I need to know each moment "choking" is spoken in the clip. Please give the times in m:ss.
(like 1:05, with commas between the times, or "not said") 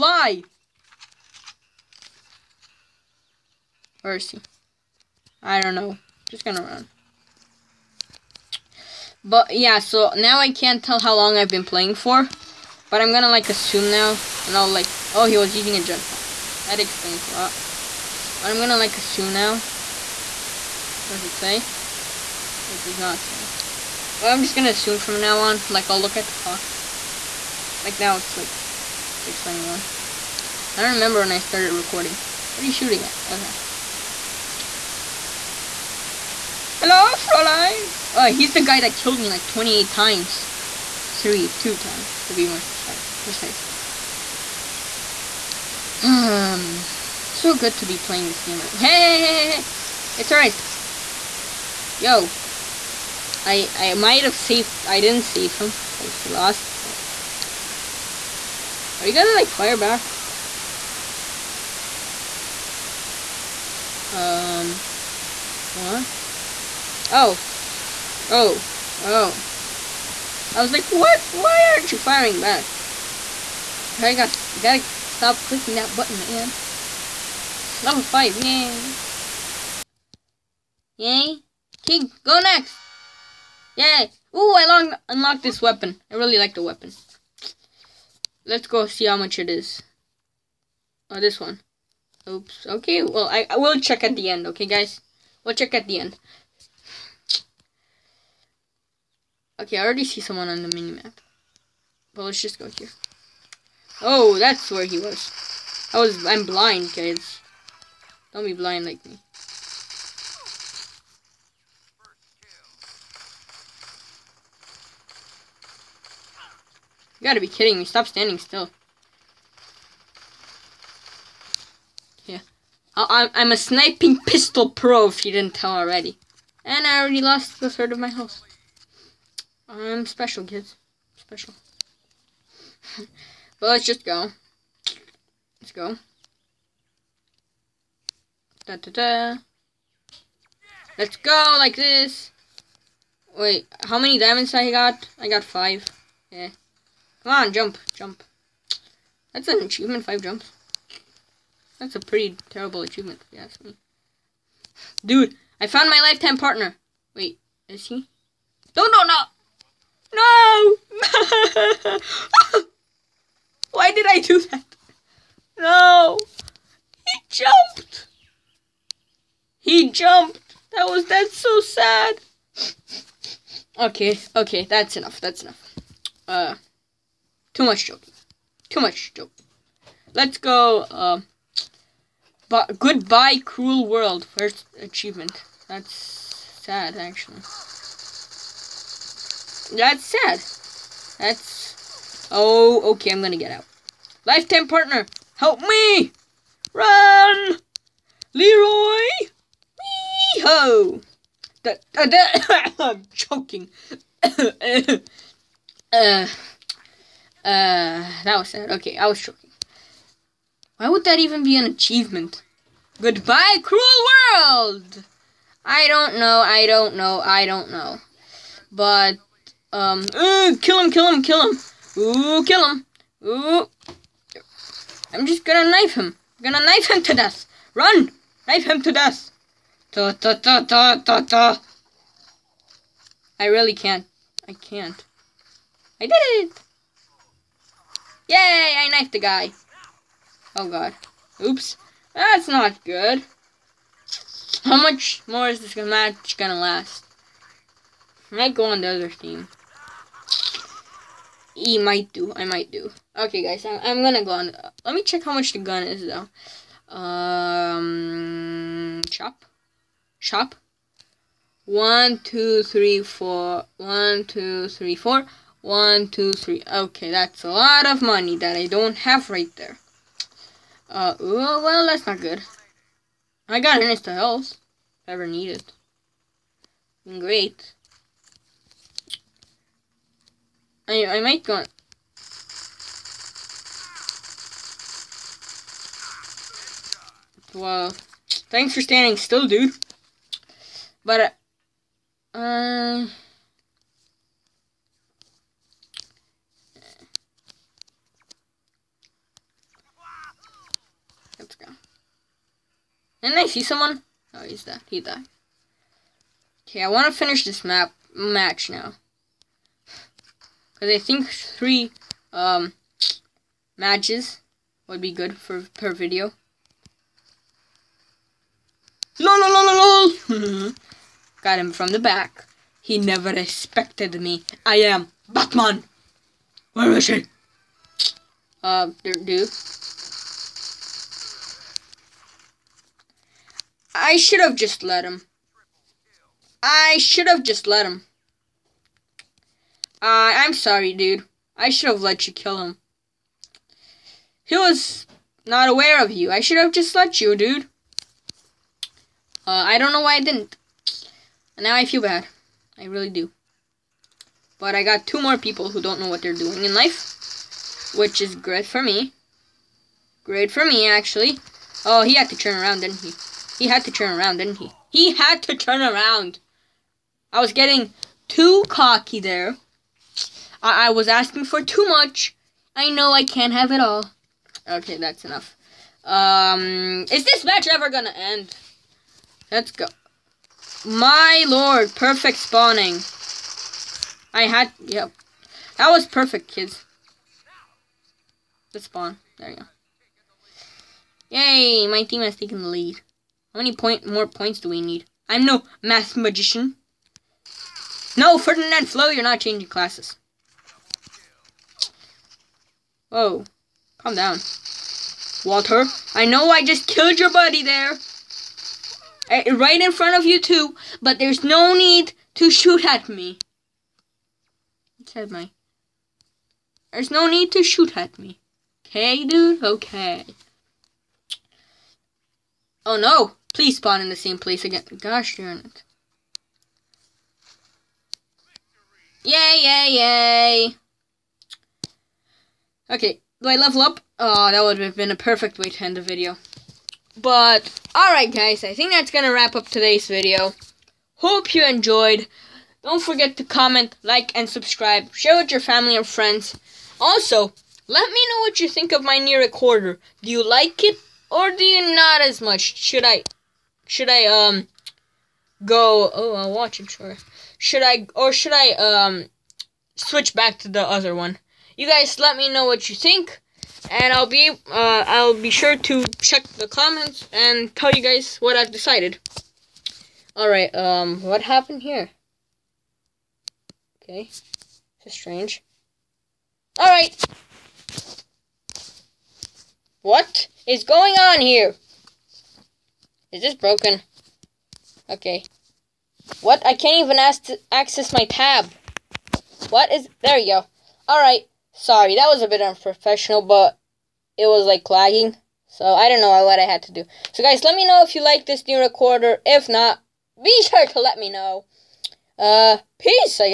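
3:23, 3:29.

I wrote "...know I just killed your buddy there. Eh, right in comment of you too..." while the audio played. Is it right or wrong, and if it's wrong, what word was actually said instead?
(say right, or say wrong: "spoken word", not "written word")
wrong: "front", not "comment".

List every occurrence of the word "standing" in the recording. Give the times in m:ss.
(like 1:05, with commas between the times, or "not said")
1:58, 4:48.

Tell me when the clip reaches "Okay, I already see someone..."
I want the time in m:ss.
1:39.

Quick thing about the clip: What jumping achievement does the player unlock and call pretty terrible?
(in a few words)
five jumps.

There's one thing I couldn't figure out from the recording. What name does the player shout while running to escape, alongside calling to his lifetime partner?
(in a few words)
Leroy.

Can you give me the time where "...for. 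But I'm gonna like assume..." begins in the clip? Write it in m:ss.
0:11.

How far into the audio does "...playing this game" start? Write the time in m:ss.
0:47.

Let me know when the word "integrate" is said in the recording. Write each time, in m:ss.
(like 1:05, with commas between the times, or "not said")
not said.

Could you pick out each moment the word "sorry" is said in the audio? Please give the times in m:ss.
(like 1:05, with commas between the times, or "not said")
5:40, 8:11.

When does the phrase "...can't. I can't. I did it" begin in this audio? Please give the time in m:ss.
3:53.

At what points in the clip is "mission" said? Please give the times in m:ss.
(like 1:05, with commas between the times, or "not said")
not said.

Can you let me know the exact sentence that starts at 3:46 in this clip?
I'm gonna knife him to death.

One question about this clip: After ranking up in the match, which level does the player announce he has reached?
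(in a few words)
Level 5.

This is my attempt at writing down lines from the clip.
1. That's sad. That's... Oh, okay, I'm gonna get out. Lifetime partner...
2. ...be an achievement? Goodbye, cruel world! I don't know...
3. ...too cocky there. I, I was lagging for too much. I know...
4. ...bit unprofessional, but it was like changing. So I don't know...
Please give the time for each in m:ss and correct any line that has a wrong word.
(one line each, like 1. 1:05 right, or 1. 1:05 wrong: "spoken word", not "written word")
1. 3:09 right
2. 3:31 right
3. 6:08 wrong: "asking", not "lagging"
4. 8:12 wrong: "lagging", not "changing".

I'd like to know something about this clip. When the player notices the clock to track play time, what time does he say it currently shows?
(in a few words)
6:21.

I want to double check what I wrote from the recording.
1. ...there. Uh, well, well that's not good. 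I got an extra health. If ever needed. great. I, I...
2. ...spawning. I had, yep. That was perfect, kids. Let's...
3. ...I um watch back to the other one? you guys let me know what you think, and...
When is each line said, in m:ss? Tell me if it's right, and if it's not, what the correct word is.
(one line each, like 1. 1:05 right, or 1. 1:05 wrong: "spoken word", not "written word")
1. 4:29 right
2. 6:22 right
3. 7:38 wrong: "switch", not "watch".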